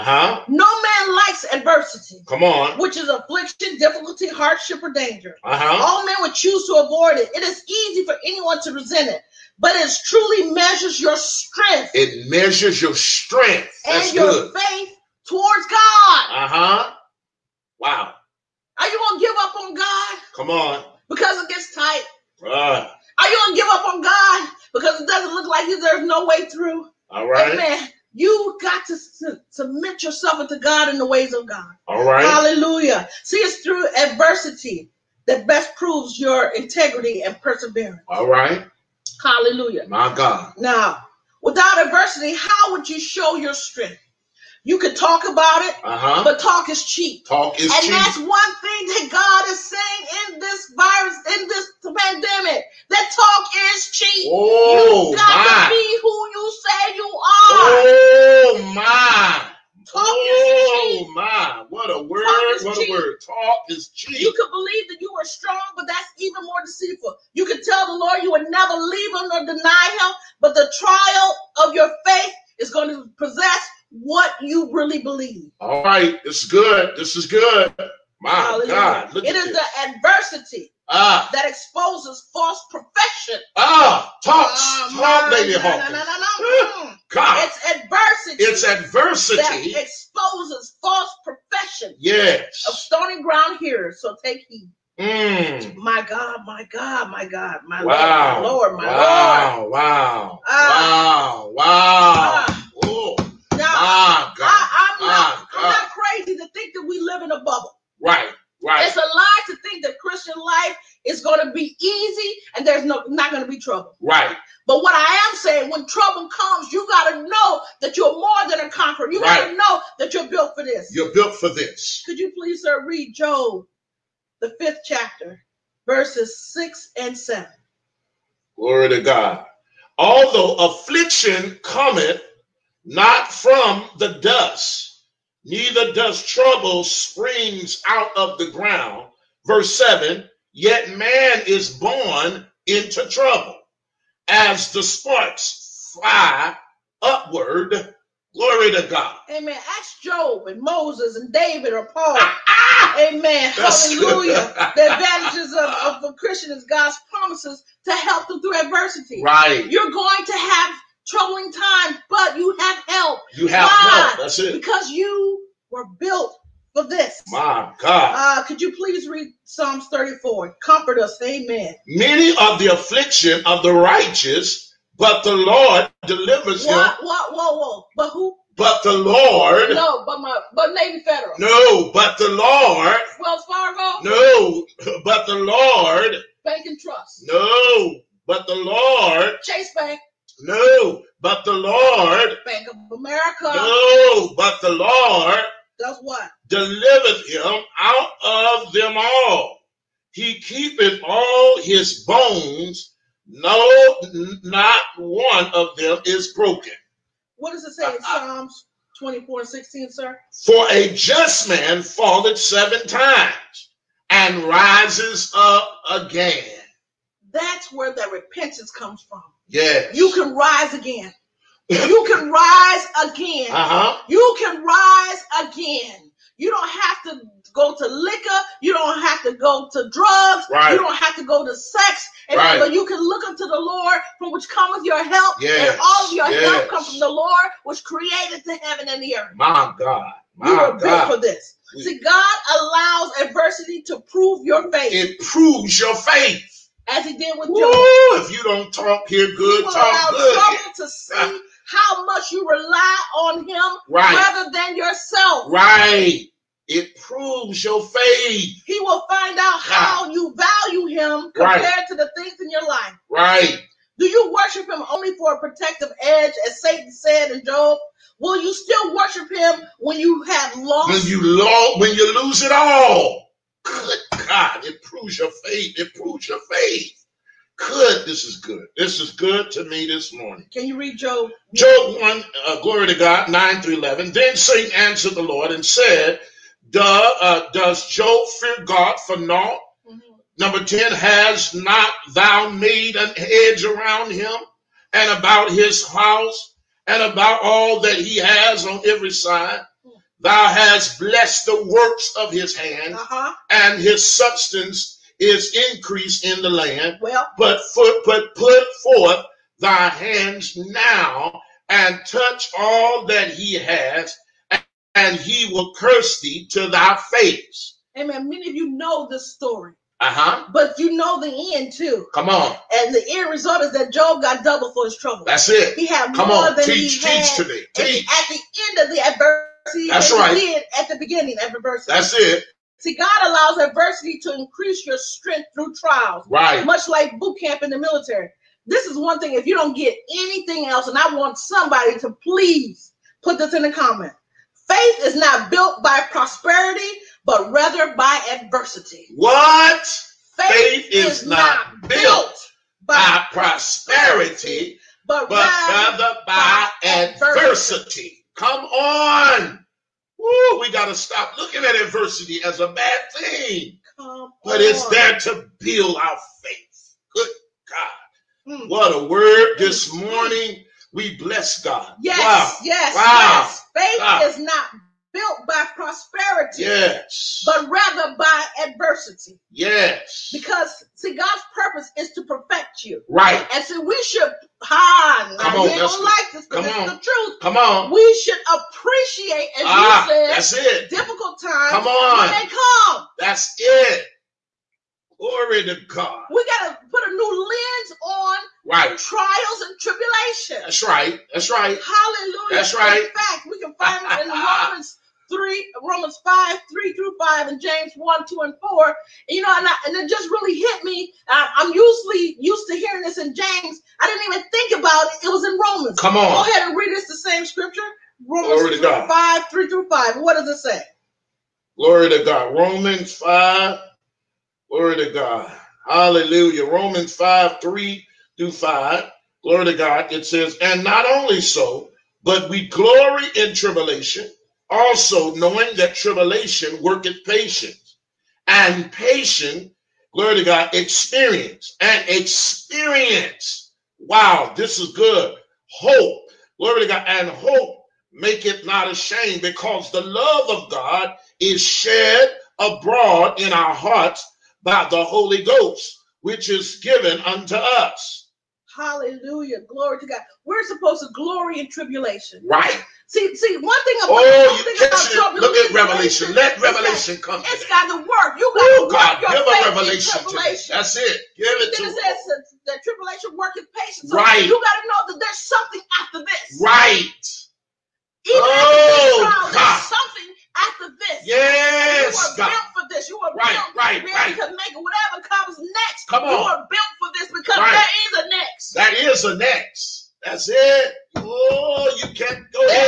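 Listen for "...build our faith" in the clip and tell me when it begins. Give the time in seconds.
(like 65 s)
365 s.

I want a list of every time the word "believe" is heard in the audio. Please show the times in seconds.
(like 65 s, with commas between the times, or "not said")
64 s, 75 s.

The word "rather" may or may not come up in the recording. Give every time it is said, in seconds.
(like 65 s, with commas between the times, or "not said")
254 s, 347 s, 355 s, 377 s.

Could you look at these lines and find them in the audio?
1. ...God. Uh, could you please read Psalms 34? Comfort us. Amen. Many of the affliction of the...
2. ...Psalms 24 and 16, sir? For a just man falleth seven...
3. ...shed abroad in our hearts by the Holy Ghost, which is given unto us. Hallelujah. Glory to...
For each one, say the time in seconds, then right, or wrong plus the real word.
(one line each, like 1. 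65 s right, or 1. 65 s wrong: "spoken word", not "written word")
1. 167 s right
2. 208 s right
3. 451 s right.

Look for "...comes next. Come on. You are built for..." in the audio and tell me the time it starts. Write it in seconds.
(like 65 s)
485 s.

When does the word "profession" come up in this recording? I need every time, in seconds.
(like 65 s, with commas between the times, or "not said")
82 s, 91 s.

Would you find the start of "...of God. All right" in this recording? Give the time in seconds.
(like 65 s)
31 s.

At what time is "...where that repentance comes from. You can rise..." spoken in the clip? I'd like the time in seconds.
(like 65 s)
217 s.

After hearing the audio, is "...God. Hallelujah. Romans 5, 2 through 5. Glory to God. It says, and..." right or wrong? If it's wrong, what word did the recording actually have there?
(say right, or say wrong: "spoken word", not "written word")
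wrong: "3", not "2".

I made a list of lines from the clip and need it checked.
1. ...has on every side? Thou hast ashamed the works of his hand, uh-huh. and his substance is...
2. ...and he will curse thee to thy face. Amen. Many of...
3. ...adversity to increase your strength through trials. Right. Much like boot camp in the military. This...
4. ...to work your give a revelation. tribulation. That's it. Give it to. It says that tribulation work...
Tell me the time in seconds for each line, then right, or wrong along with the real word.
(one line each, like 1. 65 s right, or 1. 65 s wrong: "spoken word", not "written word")
1. 298 s wrong: "blessed", not "ashamed"
2. 314 s right
3. 333 s right
4. 468 s right.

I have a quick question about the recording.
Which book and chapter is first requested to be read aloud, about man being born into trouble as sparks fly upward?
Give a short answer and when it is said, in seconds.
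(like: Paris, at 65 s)
Job 5, at 123 s.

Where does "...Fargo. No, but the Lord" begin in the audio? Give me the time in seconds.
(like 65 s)
183 s.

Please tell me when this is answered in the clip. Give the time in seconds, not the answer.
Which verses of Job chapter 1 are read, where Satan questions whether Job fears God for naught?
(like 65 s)
283 s.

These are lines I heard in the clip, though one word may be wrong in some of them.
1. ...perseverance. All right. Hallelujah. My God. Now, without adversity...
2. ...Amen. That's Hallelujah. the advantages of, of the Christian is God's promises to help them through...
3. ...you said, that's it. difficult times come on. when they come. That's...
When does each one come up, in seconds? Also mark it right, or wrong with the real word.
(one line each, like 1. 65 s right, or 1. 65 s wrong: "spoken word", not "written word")
1. 37 s right
2. 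152 s right
3. 390 s right.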